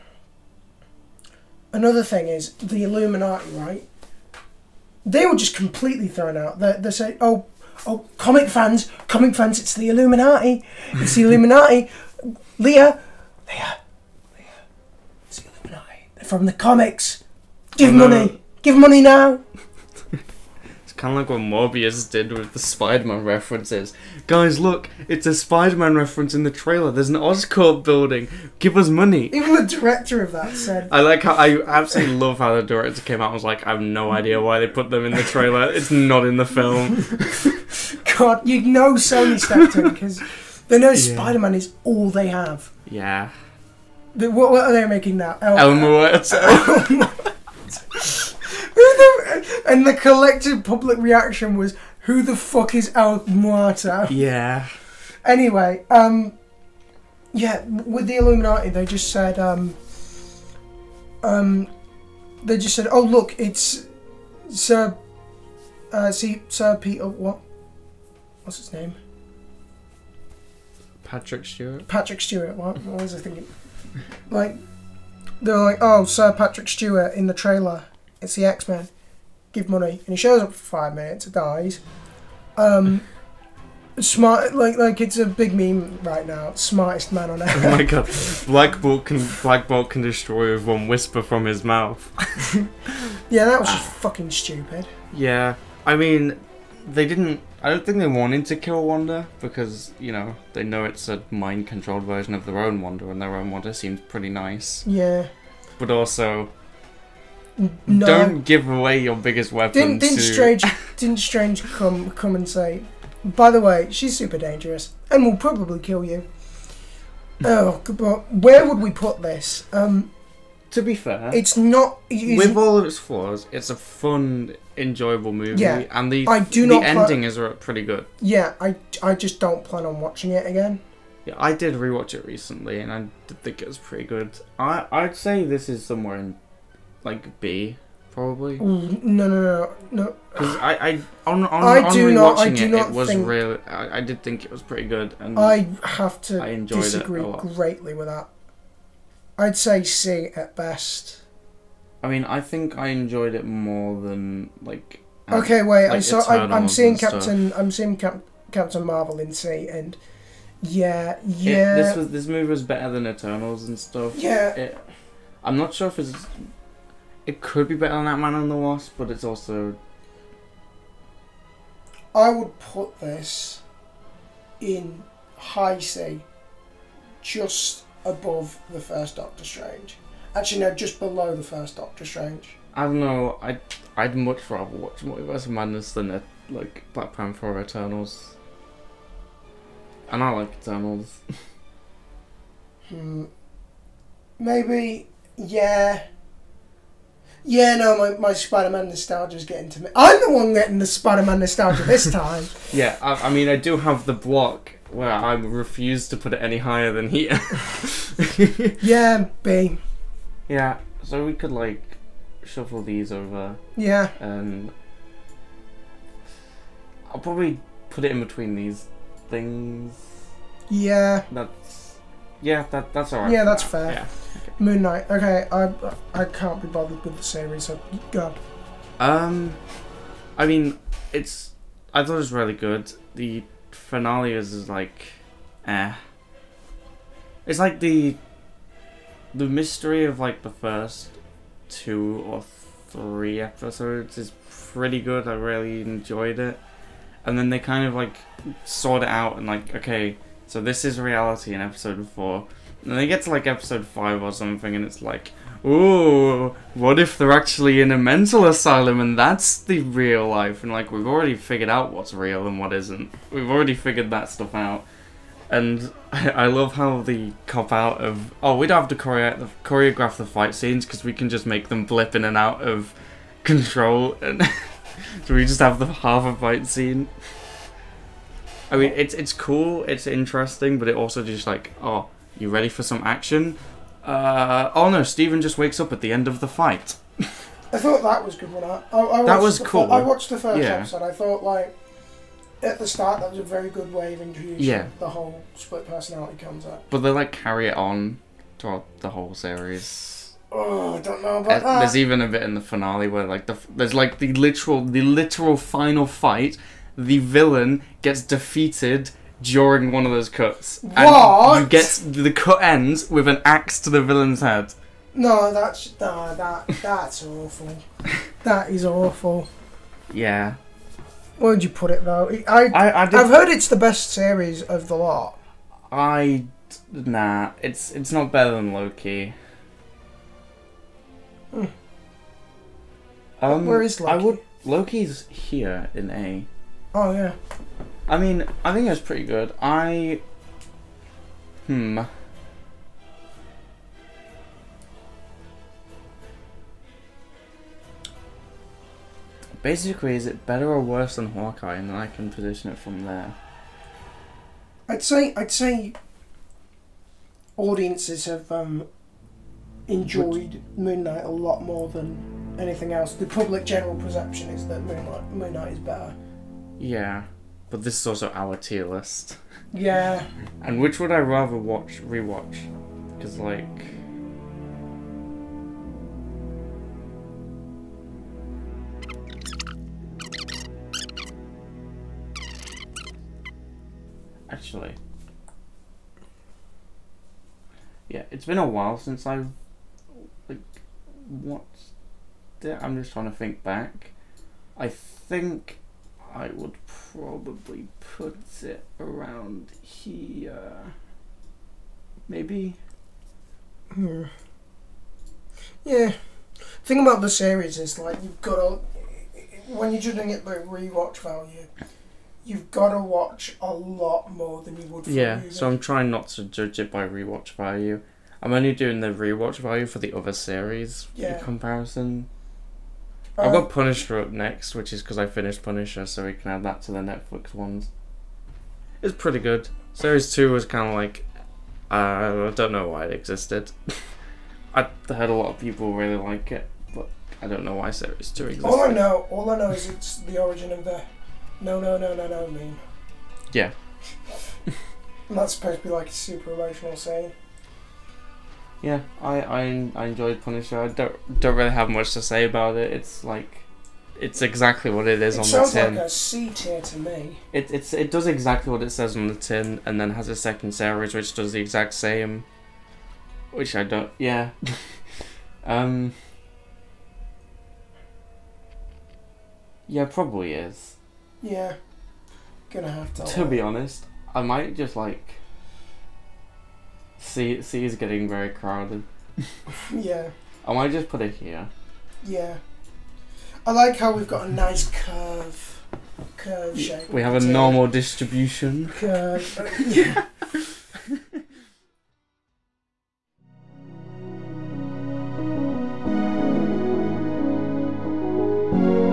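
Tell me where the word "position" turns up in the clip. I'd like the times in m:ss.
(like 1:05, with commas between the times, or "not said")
5:52.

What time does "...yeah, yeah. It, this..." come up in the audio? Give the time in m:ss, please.
2:40.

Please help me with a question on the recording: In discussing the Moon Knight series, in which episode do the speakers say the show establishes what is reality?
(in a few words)
episode 4.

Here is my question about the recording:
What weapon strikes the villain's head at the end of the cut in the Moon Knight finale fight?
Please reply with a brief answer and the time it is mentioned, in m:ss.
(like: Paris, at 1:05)
an axe, at 5:13.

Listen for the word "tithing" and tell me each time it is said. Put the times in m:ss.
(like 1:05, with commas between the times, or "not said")
not said.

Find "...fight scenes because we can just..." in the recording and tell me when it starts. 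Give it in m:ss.
4:30.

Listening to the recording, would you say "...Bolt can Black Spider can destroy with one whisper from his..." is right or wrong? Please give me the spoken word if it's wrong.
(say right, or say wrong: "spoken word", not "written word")
wrong: "Bolt", not "Spider".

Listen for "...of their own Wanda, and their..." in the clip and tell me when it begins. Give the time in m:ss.
1:42.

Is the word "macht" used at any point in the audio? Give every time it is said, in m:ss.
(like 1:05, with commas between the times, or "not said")
not said.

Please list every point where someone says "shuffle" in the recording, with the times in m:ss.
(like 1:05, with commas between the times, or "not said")
3:32.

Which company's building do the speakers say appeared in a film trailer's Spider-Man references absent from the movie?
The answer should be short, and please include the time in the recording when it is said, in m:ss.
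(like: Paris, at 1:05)
Oscorp, at 0:27.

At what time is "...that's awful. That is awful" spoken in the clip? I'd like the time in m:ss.
5:16.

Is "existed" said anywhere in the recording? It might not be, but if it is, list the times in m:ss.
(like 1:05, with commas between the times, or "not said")
7:13, 7:18.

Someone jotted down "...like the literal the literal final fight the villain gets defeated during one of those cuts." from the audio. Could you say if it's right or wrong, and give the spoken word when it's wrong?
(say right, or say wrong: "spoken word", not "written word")
right.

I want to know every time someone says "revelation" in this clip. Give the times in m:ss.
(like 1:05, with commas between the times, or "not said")
not said.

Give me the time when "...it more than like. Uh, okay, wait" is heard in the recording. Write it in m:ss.
2:33.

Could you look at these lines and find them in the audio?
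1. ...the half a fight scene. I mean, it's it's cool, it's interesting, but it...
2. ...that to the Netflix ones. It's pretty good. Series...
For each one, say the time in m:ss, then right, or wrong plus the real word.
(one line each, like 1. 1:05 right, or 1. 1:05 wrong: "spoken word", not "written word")
1. 4:35 right
2. 7:06 right.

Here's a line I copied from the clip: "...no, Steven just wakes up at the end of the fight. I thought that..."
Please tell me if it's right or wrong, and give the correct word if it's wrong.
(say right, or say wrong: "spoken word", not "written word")
right.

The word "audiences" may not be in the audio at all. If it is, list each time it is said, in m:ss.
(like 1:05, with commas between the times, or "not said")
5:57.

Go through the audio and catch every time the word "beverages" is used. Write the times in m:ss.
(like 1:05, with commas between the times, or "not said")
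not said.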